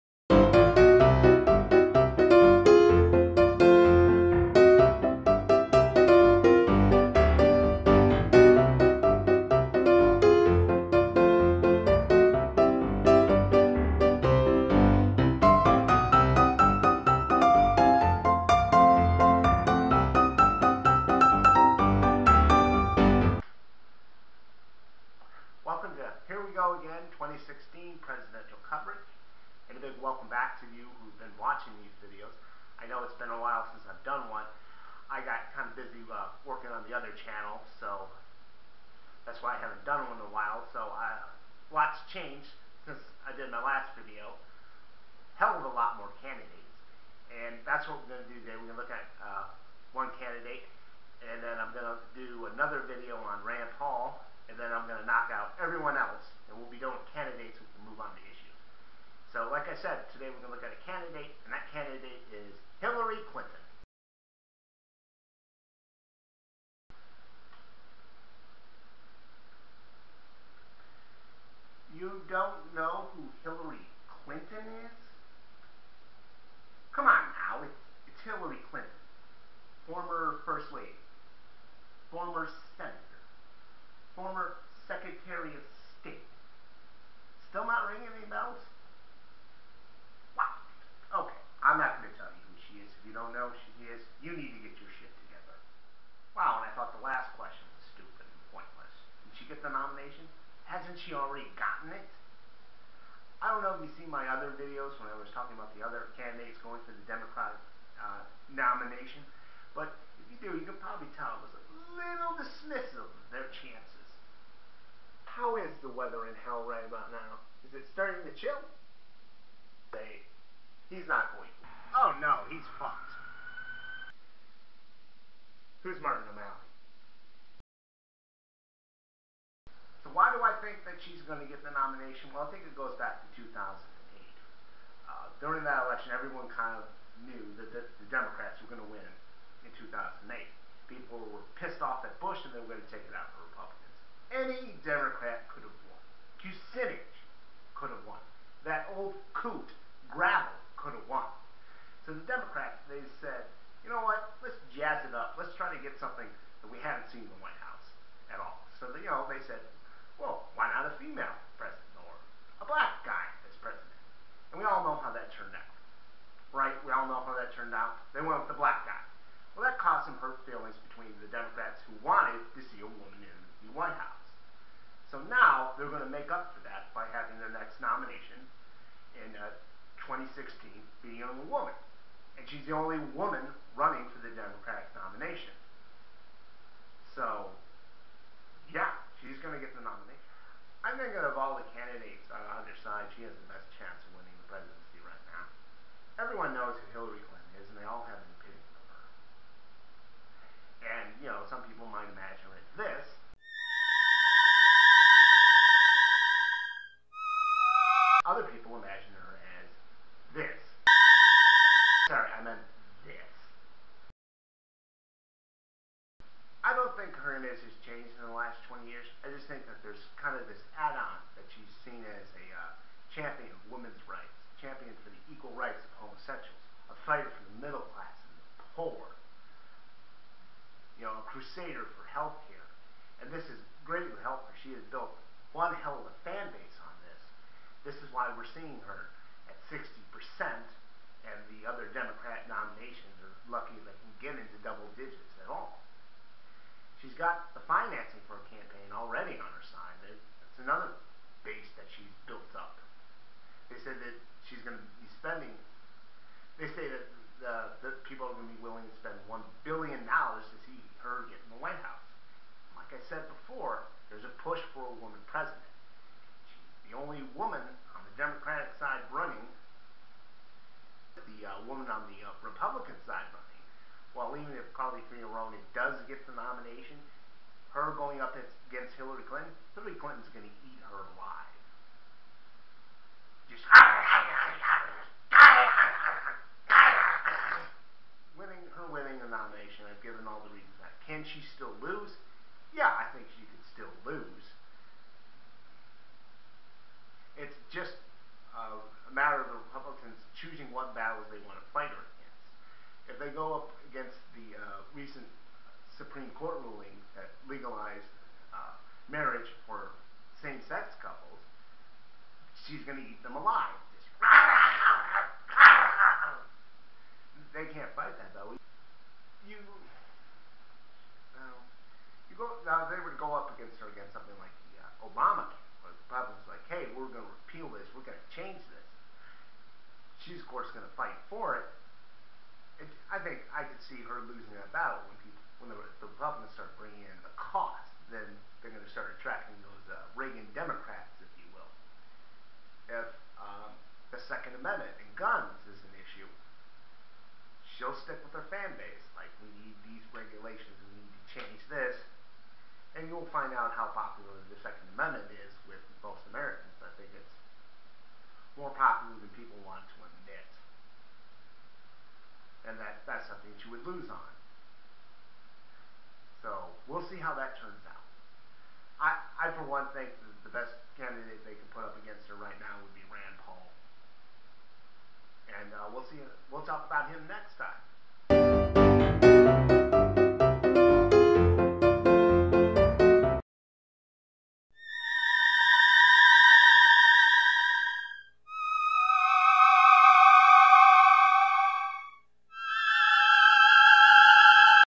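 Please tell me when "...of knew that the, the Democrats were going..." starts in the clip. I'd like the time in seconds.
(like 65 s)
136 s.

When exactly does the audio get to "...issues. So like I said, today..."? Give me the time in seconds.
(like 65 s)
58 s.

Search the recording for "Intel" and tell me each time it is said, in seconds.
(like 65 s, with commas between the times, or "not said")
not said.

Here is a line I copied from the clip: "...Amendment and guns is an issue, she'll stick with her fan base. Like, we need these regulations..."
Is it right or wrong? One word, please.
right.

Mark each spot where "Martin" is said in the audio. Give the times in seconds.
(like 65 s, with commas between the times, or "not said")
125 s.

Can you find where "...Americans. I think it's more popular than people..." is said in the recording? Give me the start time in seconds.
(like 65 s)
356 s.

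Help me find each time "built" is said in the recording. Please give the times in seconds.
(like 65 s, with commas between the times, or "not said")
234 s, 252 s.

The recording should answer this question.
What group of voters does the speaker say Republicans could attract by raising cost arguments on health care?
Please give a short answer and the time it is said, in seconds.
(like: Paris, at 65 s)
Reagan Democrats, at 340 s.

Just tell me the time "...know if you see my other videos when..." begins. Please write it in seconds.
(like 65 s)
103 s.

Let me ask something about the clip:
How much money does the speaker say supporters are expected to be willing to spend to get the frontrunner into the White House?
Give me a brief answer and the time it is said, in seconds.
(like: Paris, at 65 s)
$1 billion, at 259 s.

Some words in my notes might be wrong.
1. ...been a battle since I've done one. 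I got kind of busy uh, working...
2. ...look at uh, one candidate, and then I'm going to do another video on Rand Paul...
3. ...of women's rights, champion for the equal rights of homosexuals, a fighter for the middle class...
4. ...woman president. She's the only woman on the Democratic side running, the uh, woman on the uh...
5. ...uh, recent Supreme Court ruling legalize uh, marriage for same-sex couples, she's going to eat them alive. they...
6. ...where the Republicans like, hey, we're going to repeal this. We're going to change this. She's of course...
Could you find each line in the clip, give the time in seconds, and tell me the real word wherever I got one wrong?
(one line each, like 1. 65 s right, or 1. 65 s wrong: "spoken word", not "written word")
1. 33 s wrong: "while", not "battle"
2. 48 s right
3. 223 s right
4. 265 s right
5. 304 s right
6. 325 s right.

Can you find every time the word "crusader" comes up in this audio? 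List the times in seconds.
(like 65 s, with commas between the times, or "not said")
231 s.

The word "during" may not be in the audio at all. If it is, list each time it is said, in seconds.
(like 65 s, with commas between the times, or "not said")
135 s.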